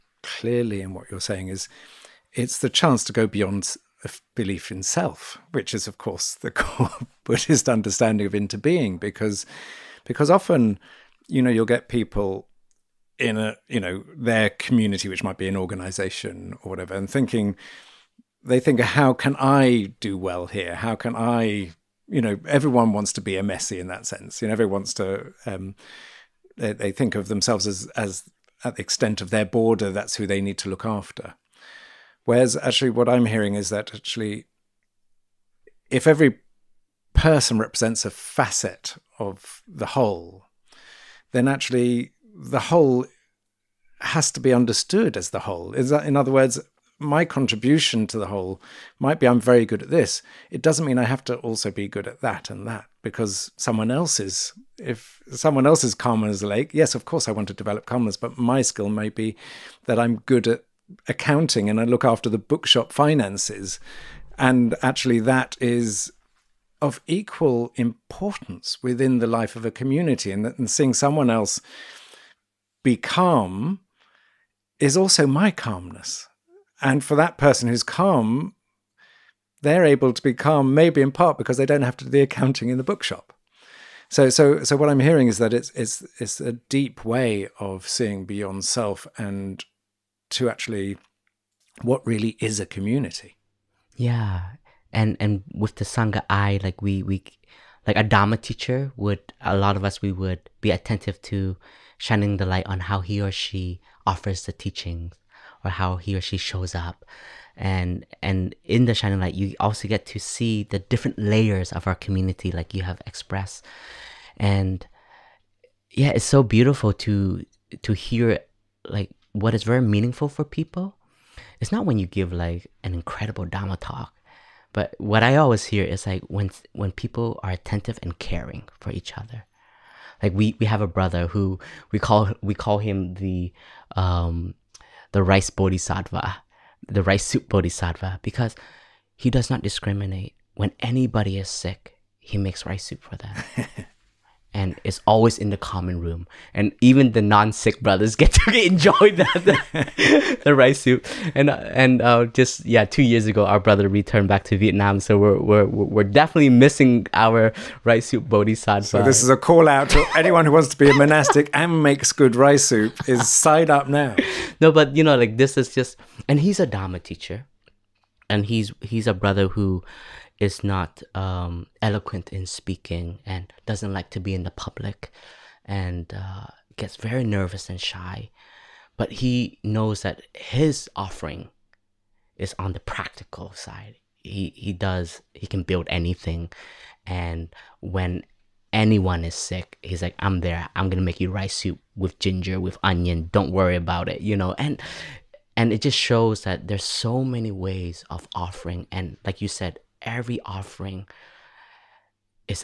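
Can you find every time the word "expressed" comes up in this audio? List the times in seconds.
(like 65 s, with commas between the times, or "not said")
113 s.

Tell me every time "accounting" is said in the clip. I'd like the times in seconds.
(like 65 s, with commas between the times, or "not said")
61 s, 82 s.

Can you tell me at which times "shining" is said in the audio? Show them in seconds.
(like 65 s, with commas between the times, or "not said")
101 s, 108 s.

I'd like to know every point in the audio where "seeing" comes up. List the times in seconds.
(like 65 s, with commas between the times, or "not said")
70 s, 87 s.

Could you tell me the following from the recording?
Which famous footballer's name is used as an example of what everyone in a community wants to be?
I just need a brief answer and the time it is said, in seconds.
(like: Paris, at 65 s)
Messi, at 23 s.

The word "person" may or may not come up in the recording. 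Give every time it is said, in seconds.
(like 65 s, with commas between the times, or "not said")
37 s, 77 s.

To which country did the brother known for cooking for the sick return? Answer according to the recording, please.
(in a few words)
Vietnam.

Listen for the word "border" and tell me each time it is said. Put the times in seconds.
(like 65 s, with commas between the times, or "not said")
29 s.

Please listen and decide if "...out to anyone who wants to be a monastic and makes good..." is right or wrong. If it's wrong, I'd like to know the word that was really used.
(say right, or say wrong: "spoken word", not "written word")
right.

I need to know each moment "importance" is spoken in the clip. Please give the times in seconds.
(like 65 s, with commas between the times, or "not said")
67 s.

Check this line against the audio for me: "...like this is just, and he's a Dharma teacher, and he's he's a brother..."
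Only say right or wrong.
right.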